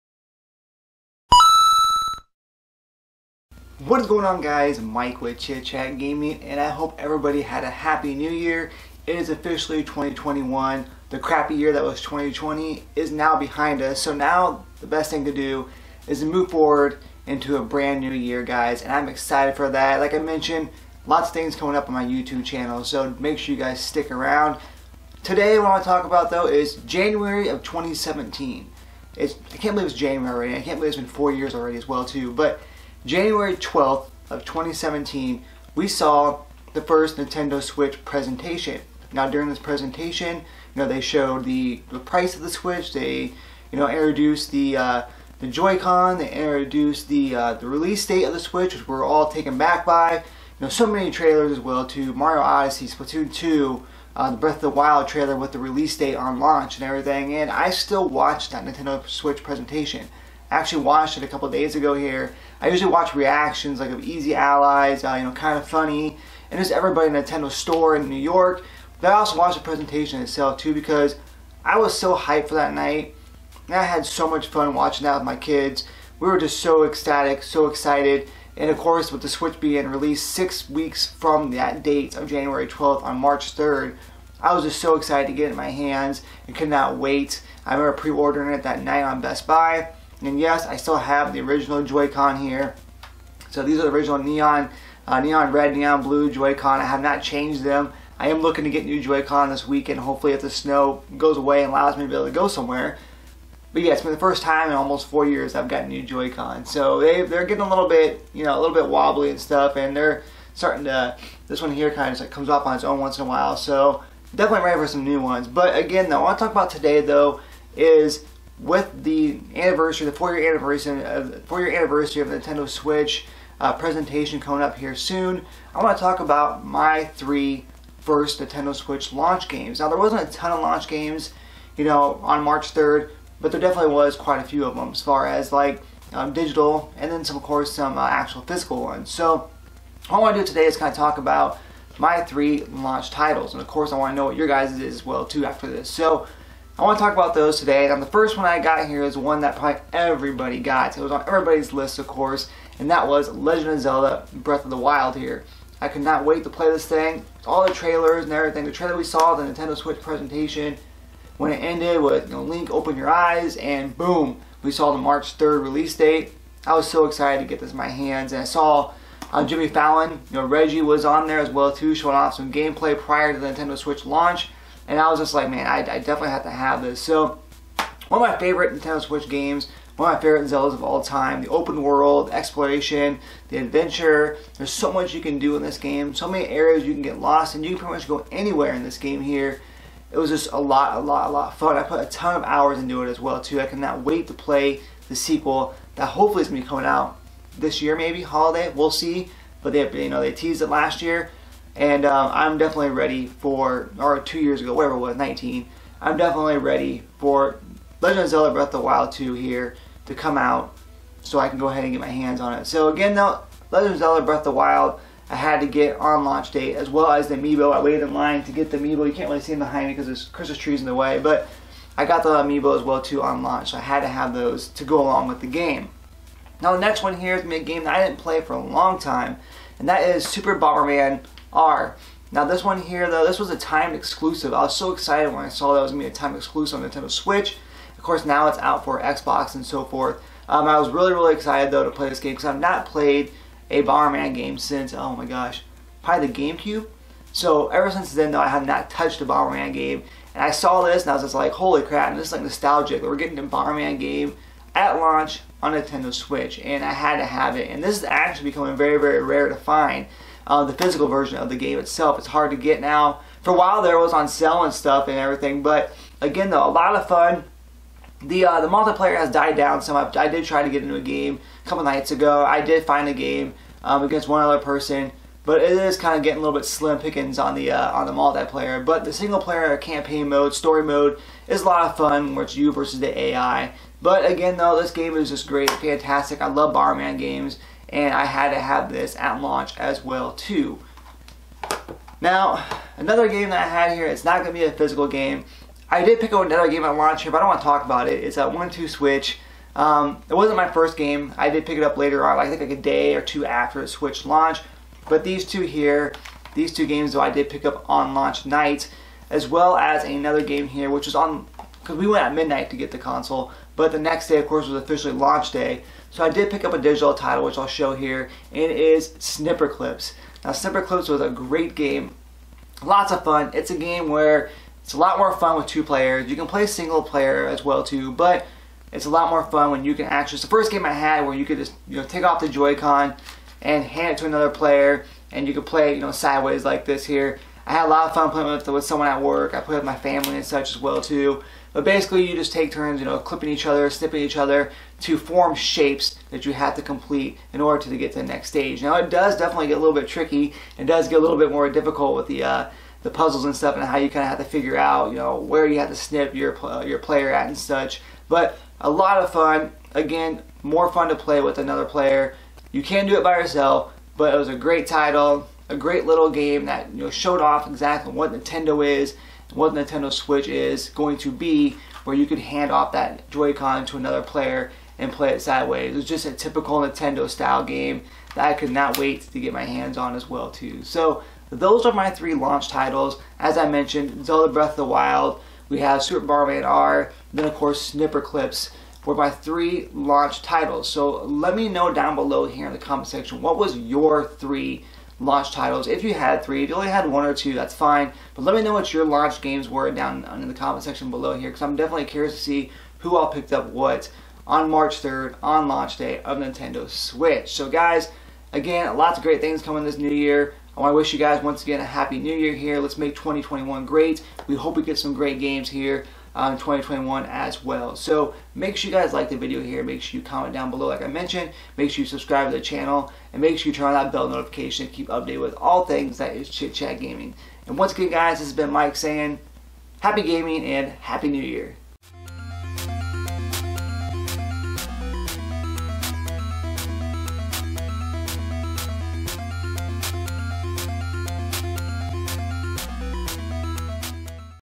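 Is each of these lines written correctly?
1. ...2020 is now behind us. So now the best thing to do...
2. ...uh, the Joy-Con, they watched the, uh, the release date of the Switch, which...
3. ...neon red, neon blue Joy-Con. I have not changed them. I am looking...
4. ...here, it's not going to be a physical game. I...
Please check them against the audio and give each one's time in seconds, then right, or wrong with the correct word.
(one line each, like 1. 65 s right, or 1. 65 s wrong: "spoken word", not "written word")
1. 12 s right
2. 44 s wrong: "introduced", not "watched"
3. 95 s right
4. 293 s right.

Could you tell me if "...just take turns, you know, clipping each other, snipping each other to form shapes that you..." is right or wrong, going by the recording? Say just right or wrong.
right.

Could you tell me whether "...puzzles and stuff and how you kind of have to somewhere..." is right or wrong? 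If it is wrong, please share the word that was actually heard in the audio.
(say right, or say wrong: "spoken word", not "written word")
wrong: "figure", not "somewhere".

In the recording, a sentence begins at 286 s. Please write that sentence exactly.
I love Bomberman games and I had to have this at launch as well too.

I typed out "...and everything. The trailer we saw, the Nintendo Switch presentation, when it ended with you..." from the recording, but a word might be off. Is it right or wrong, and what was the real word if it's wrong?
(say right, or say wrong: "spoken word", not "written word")
right.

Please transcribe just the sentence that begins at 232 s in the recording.
Now this one here though, this was a timed exclusive.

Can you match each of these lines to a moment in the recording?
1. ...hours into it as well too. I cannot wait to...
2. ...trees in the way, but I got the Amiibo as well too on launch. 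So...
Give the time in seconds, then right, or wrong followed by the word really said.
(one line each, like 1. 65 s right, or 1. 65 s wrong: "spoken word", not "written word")
1. 192 s right
2. 220 s right.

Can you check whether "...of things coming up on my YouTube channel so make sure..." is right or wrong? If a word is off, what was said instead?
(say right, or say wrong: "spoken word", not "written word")
right.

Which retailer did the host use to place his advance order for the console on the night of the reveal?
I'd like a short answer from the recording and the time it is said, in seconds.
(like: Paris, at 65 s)
Best Buy, at 89 s.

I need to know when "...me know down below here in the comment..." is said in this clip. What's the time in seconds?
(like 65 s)
391 s.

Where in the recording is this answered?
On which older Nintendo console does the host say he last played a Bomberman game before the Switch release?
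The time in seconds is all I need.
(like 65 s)
246 s.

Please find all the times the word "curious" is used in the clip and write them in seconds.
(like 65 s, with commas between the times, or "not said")
402 s.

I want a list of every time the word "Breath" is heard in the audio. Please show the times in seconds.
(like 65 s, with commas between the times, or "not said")
54 s, 154 s, 208 s, 214 s, 384 s.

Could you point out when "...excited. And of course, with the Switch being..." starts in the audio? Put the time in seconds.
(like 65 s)
77 s.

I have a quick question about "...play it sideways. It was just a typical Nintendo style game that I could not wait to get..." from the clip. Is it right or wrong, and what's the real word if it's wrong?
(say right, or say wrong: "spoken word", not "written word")
right.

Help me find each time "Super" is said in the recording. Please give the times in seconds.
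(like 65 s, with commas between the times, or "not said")
230 s, 386 s.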